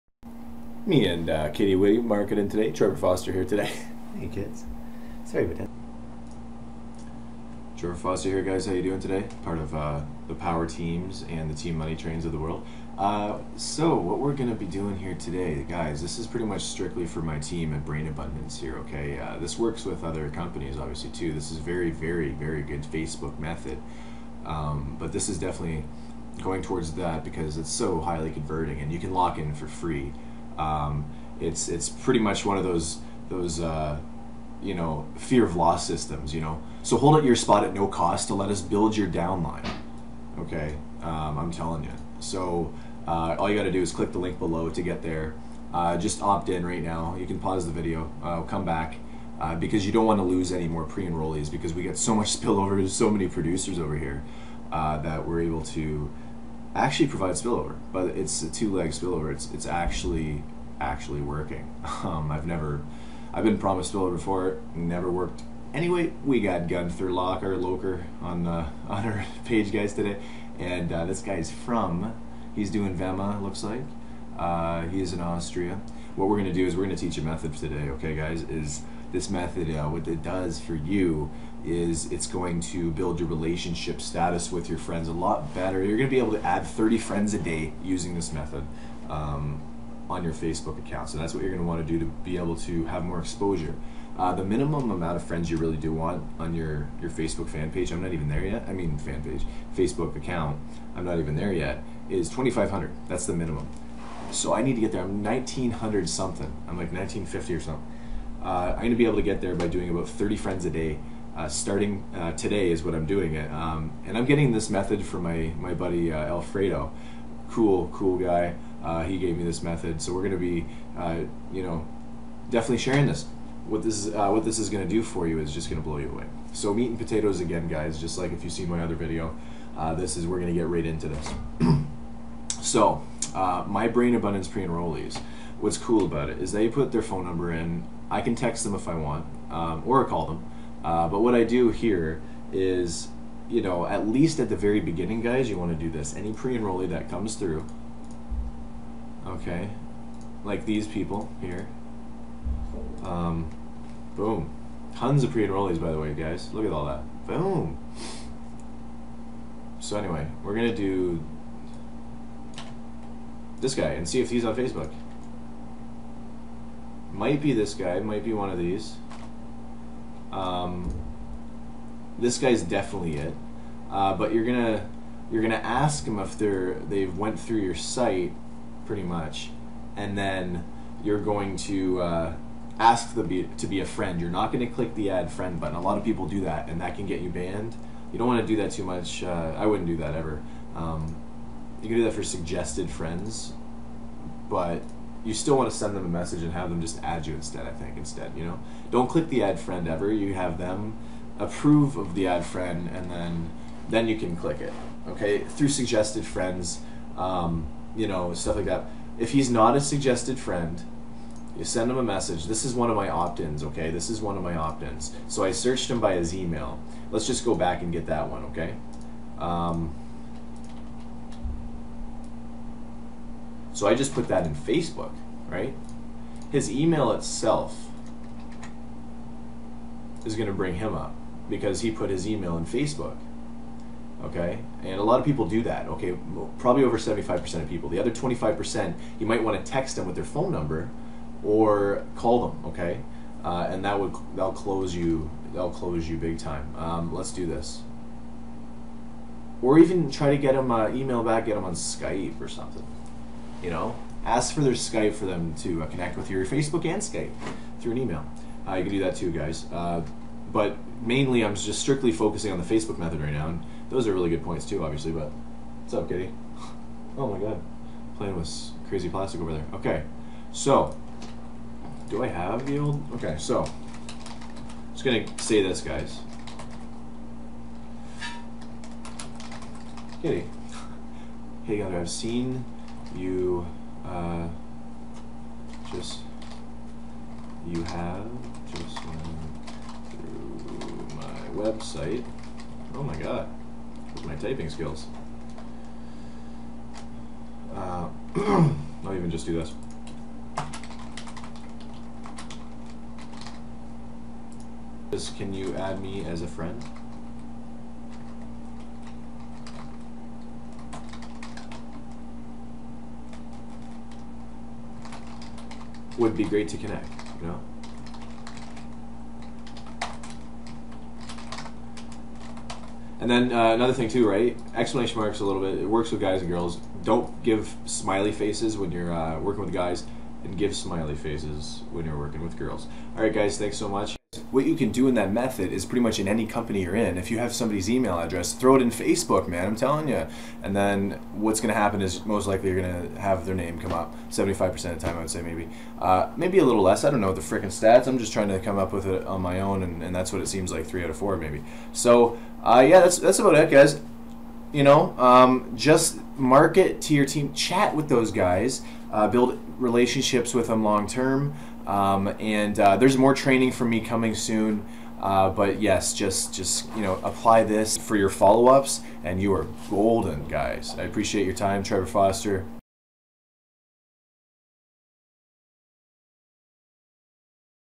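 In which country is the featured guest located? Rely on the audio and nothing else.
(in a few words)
Austria.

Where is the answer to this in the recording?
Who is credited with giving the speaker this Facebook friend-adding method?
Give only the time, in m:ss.
1:56.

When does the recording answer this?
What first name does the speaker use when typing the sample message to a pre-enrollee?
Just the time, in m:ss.
4:41.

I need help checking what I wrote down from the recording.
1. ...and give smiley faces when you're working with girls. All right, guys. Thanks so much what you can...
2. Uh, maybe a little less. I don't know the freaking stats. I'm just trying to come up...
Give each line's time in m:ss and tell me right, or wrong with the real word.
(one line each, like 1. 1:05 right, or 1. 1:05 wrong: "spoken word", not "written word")
1. 5:30 right
2. 5:45 right.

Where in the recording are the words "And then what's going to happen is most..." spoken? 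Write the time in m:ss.
5:40.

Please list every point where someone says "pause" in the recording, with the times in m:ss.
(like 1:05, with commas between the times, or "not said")
0:47.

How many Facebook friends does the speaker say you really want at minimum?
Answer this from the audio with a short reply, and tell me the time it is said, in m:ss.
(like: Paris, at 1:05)
2,500, at 1:42.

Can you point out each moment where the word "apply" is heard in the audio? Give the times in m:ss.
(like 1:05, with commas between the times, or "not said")
6:07.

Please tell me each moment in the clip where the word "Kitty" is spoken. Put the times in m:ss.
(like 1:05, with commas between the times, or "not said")
0:01, 4:26, 4:40.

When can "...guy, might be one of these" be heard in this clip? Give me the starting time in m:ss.
2:47.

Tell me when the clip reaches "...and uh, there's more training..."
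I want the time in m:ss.
6:02.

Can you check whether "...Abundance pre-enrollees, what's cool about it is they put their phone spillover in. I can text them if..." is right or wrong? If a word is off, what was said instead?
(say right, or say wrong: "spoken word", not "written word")
wrong: "number", not "spillover".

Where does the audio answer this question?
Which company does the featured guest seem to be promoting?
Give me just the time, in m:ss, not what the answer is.
1:12.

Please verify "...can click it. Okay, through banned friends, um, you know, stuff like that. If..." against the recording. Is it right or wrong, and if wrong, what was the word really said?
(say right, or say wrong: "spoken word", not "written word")
wrong: "suggested", not "banned".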